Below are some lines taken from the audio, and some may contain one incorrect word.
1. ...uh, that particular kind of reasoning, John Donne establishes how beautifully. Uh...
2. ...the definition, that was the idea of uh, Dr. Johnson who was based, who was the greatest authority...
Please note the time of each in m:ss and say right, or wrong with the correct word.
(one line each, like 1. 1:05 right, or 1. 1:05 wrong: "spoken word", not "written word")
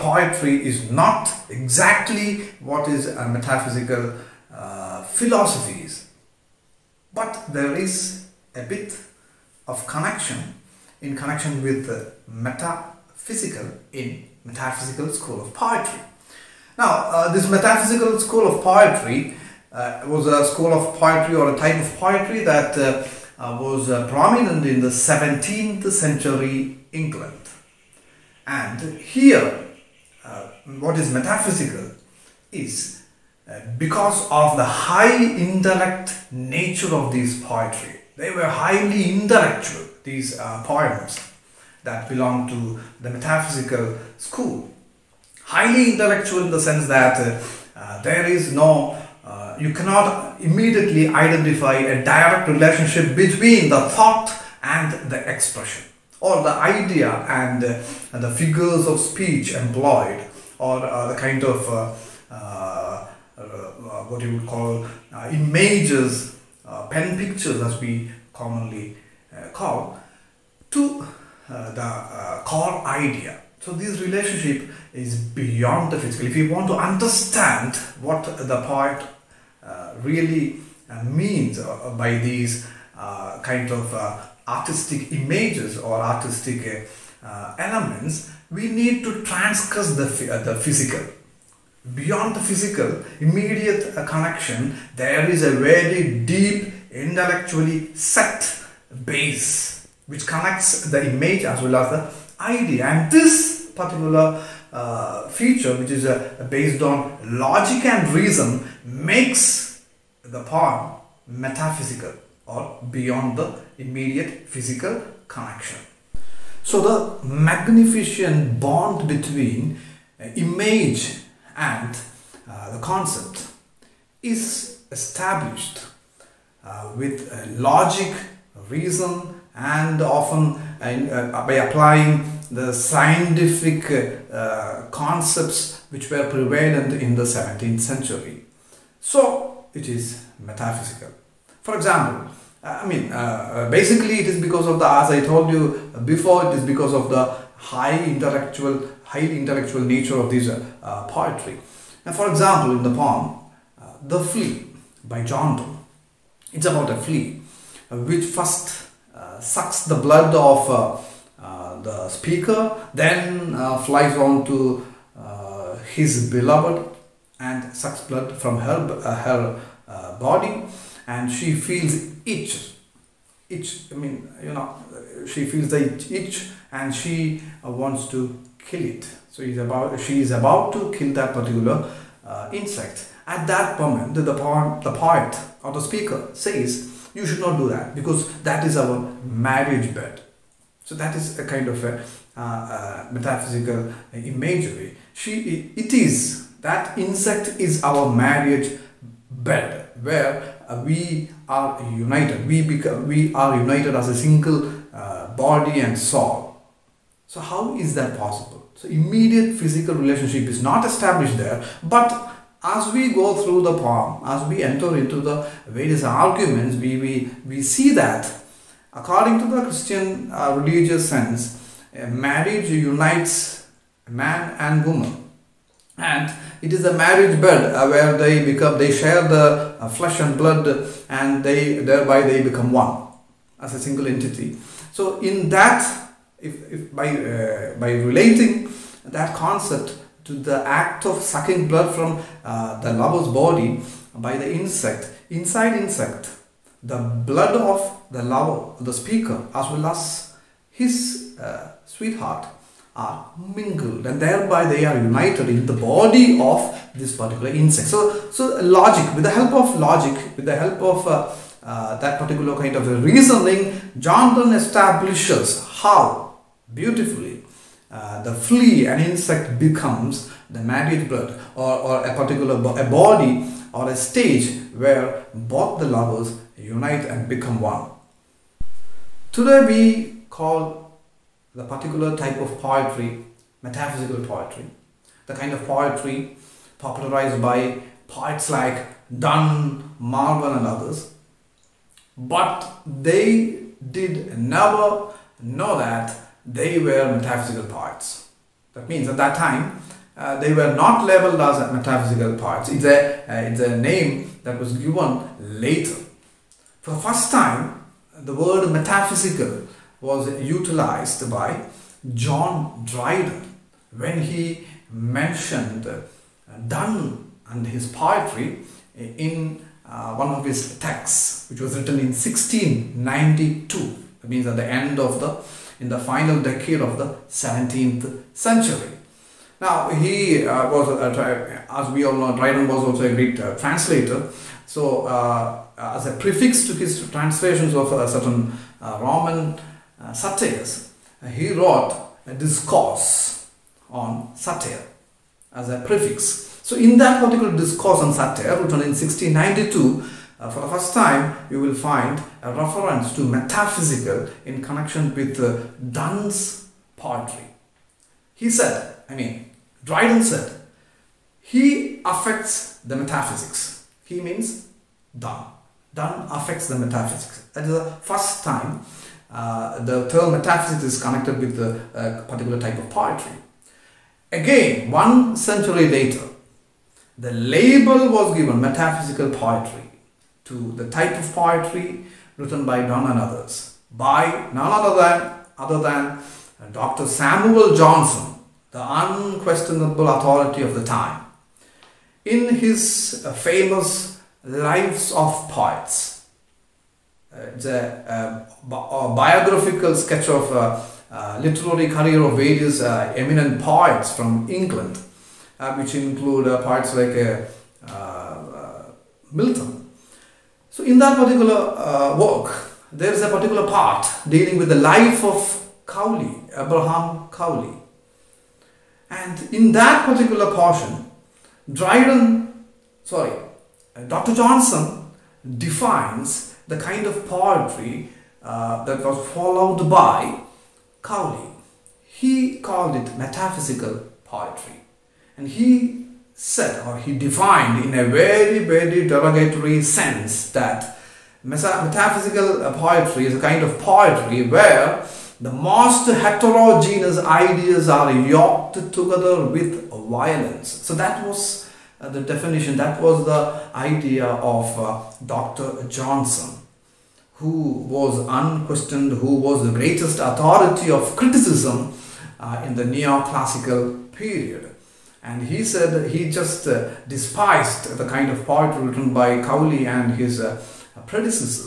1. 4:21 right
2. 7:32 wrong: "unquestioned", not "based".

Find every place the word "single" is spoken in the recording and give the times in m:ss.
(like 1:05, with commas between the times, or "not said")
3:24, 3:53.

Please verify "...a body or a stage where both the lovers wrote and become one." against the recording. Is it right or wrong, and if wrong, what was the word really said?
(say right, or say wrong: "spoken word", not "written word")
wrong: "unite", not "wrote".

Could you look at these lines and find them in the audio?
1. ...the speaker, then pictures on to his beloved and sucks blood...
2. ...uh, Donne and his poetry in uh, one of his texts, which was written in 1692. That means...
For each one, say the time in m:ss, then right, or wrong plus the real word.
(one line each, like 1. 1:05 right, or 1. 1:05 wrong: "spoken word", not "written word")
1. 2:41 wrong: "flies", not "pictures"
2. 5:15 right.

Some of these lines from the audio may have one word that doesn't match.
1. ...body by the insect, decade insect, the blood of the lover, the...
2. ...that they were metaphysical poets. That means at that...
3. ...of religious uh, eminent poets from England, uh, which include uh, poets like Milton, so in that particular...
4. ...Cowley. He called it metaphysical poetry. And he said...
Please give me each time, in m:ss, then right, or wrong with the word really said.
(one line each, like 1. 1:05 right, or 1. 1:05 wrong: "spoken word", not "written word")
1. 4:03 wrong: "inside", not "decade"
2. 4:55 right
3. 6:42 wrong: "various", not "religious"
4. 7:11 right.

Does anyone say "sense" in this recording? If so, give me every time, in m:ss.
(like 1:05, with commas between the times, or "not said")
0:46, 3:41, 7:19.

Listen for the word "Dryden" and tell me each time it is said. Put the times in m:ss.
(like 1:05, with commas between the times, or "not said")
5:12, 5:32, 5:59, 7:01.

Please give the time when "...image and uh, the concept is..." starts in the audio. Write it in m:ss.
2:00.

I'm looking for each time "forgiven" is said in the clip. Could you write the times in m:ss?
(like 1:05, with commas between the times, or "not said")
not said.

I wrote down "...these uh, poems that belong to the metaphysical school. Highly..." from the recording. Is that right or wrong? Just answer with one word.
right.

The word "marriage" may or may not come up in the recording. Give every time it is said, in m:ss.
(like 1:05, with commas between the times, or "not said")
3:09, 3:18, 3:42, 3:46, 4:30.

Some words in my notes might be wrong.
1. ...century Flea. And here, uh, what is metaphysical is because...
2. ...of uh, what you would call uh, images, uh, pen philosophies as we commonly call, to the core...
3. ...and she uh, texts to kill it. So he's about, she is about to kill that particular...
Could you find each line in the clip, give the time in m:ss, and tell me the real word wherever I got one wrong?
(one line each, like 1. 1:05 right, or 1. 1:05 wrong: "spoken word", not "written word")
1. 0:25 wrong: "England", not "Flea"
2. 1:01 wrong: "pictures", not "philosophies"
3. 2:56 wrong: "wants", not "texts".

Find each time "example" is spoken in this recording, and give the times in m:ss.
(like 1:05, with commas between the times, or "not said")
2:21, 2:32.